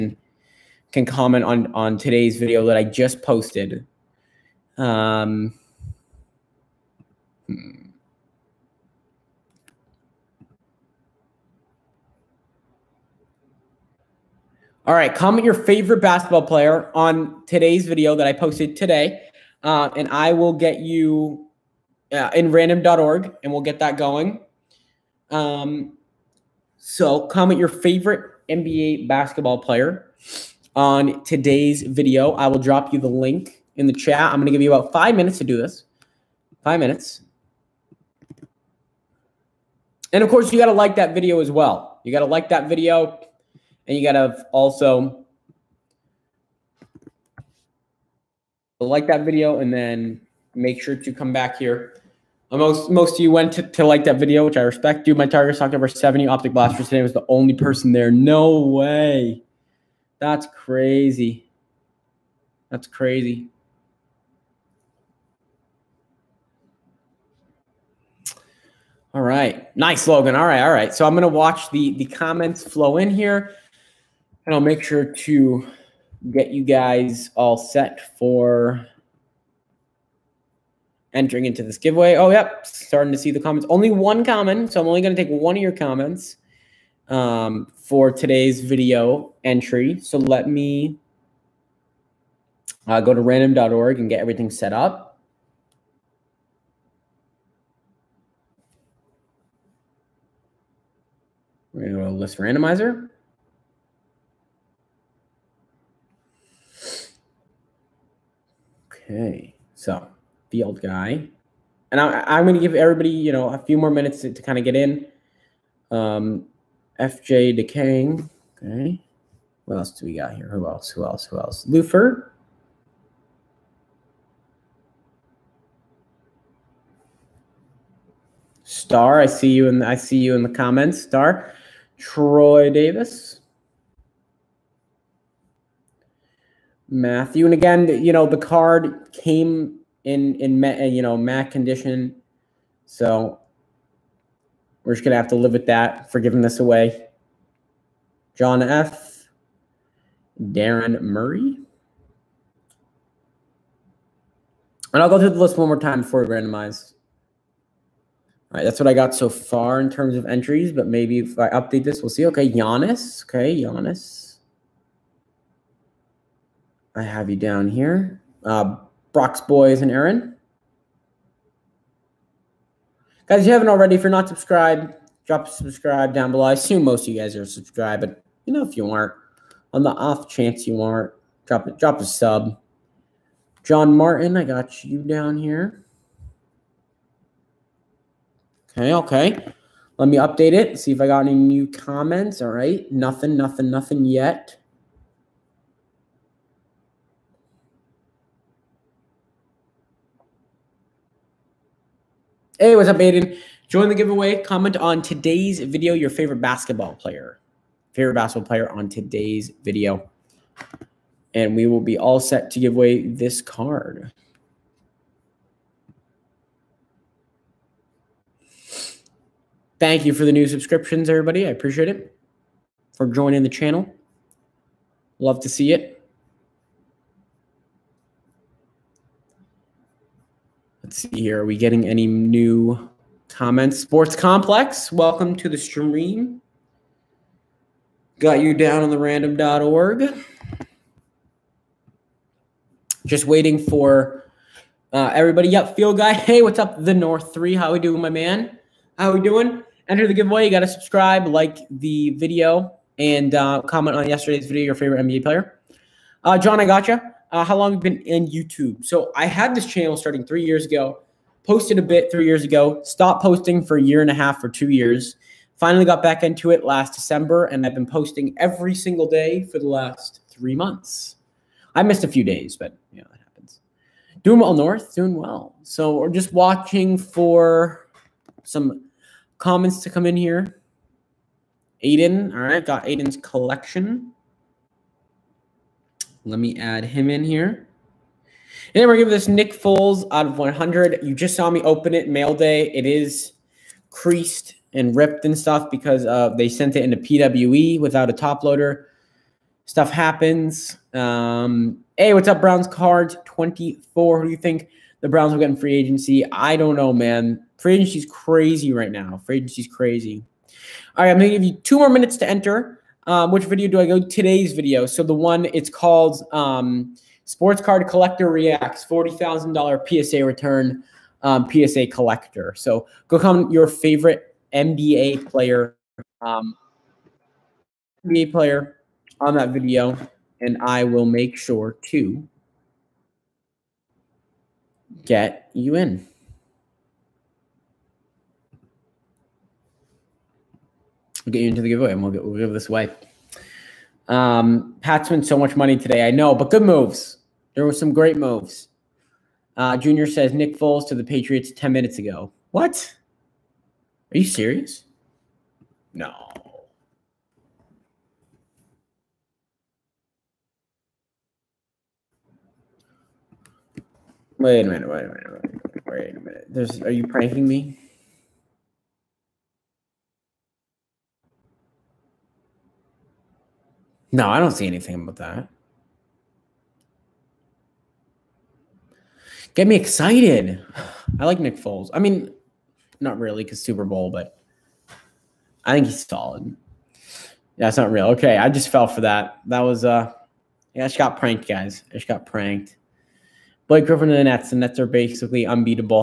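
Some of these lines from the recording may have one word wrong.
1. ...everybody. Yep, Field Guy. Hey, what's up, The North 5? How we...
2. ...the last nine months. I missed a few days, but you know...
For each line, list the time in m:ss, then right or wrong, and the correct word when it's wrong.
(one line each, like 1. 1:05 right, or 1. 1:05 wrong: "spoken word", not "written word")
1. 4:05 wrong: "3", not "5"
2. 4:29 wrong: "three", not "nine".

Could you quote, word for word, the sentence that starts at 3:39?
Thank you for the new subscriptions, everybody.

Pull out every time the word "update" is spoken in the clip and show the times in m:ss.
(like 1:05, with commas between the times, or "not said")
2:41, 3:10.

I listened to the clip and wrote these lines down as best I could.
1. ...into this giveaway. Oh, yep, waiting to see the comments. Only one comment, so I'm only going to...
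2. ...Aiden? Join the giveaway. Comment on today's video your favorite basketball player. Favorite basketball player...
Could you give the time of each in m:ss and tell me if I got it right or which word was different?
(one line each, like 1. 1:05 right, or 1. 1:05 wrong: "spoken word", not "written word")
1. 1:21 wrong: "starting", not "waiting"
2. 3:22 right.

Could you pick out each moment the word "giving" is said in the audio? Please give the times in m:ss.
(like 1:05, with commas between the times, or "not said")
2:26, 4:48.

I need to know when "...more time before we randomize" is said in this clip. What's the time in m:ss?
2:35.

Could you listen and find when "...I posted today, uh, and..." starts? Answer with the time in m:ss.
0:18.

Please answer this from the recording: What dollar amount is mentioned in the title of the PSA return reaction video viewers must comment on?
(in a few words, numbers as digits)
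$40,000.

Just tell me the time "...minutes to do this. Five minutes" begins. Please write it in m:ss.
0:35.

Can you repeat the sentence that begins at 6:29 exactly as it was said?
That was uh yeah, I just got pranked, guys.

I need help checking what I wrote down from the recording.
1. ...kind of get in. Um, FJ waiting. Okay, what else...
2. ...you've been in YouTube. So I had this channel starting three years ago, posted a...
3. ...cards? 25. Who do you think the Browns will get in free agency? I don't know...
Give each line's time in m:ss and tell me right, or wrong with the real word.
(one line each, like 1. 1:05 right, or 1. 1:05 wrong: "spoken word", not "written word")
1. 1:54 wrong: "decaying", not "waiting"
2. 4:17 right
3. 5:02 wrong: "24", not "25".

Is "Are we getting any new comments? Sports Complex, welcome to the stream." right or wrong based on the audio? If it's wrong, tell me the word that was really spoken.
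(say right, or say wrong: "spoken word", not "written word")
right.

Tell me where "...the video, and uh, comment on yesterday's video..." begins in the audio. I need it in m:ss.
4:11.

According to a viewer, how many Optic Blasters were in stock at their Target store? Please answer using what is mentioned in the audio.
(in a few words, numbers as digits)
over 70.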